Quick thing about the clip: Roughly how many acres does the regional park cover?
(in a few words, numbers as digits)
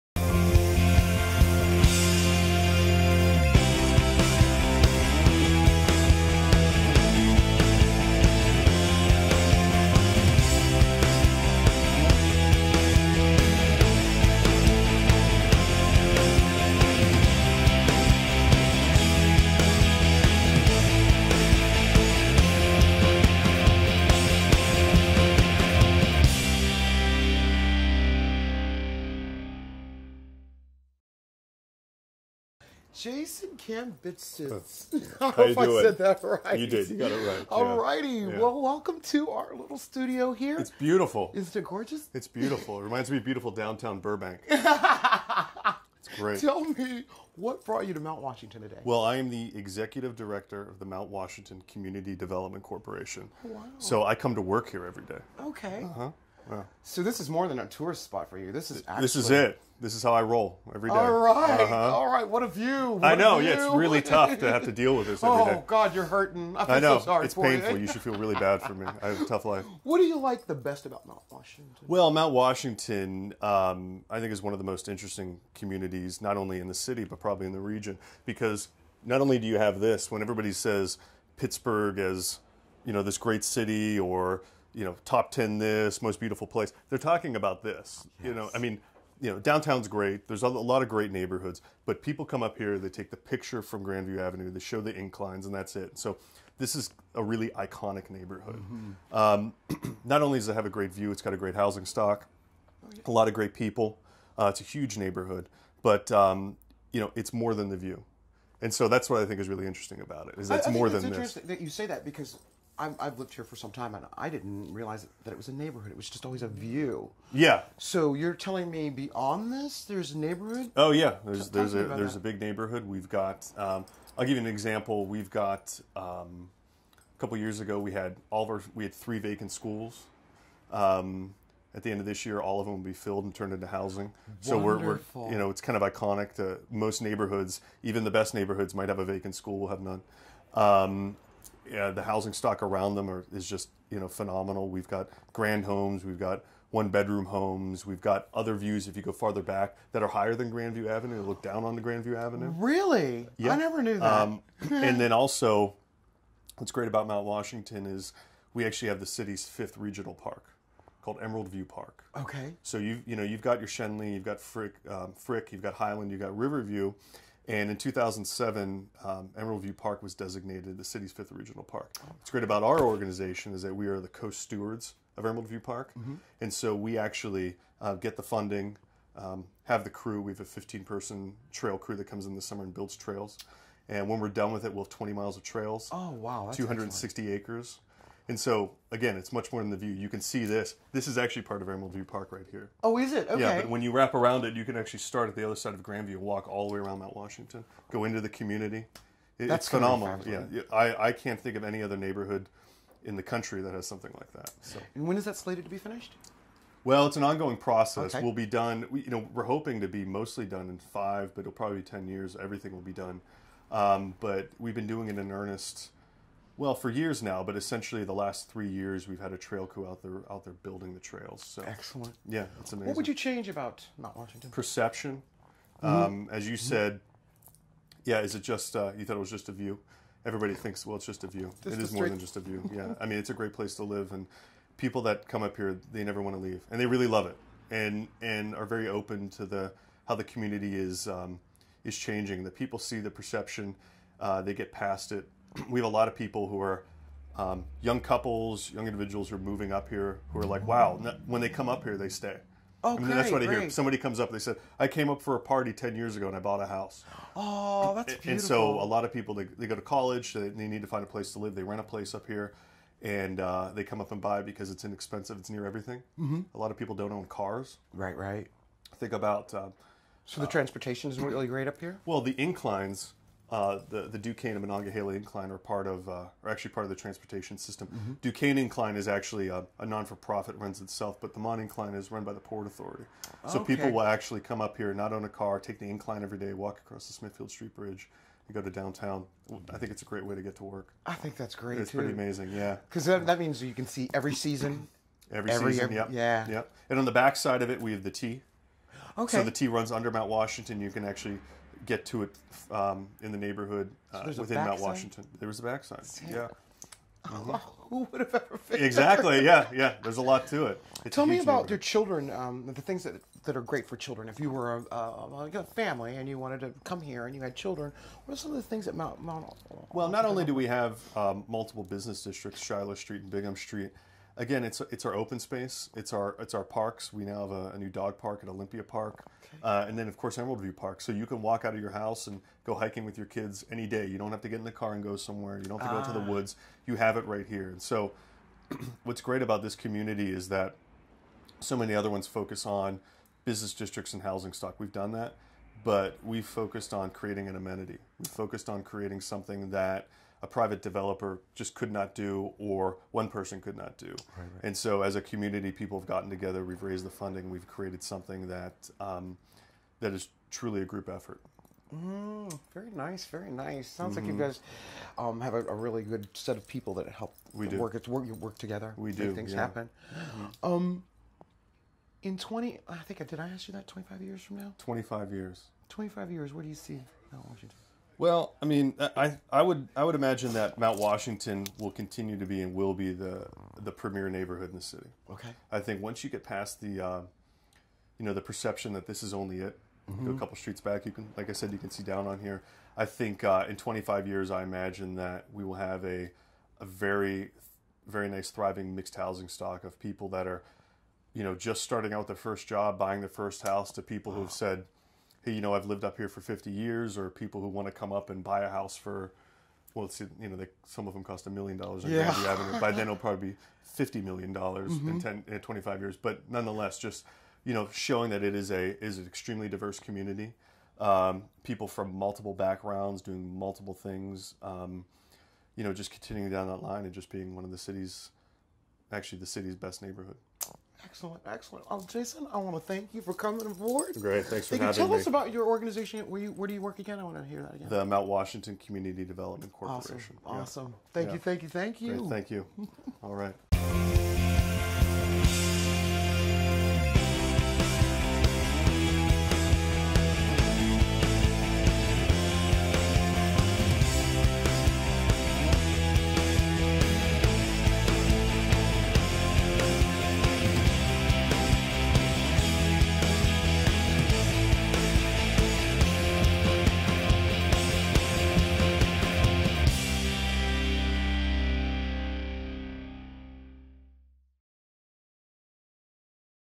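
260.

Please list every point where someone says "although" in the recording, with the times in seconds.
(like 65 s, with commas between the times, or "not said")
not said.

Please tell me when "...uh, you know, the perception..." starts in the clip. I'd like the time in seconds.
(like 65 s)
387 s.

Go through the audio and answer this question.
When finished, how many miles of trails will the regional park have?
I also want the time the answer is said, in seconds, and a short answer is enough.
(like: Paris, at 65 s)
20 miles, at 184 s.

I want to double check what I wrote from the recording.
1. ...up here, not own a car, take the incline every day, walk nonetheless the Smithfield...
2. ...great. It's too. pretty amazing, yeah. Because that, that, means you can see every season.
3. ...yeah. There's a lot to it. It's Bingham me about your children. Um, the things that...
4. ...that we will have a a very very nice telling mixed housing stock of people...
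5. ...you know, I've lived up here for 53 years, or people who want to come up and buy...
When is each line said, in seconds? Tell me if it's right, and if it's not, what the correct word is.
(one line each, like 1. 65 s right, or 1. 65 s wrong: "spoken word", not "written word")
1. 284 s wrong: "across", not "nonetheless"
2. 291 s right
3. 309 s wrong: "Tell", not "Bingham"
4. 395 s wrong: "thriving", not "telling"
5. 405 s wrong: "50", not "53".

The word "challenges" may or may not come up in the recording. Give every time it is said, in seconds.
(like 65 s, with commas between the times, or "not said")
not said.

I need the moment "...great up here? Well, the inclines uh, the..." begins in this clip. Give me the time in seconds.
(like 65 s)
271 s.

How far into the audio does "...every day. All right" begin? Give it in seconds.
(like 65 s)
60 s.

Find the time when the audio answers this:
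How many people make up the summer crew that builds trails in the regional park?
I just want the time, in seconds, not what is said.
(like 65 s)
180 s.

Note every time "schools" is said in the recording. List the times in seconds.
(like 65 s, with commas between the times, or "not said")
129 s, 139 s.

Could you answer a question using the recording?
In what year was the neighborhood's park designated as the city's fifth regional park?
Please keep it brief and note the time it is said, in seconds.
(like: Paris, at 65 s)
2007, at 167 s.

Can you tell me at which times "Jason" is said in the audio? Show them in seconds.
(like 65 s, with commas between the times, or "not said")
32 s, 432 s.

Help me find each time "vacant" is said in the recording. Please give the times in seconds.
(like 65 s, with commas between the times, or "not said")
129 s, 139 s.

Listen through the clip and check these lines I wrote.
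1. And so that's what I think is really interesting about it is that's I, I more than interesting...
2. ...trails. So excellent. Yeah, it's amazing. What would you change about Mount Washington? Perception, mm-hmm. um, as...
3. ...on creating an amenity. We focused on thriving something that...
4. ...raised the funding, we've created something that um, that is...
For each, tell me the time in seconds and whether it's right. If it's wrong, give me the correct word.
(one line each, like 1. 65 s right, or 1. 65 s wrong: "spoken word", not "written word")
1. 108 s right
2. 220 s right
3. 346 s wrong: "creating", not "thriving"
4. 356 s right.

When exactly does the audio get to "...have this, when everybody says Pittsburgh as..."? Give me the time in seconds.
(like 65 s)
79 s.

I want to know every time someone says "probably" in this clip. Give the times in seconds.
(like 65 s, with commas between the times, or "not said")
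77 s, 211 s, 413 s.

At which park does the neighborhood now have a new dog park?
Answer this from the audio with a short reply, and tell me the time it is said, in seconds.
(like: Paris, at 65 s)
Olympia Park, at 328 s.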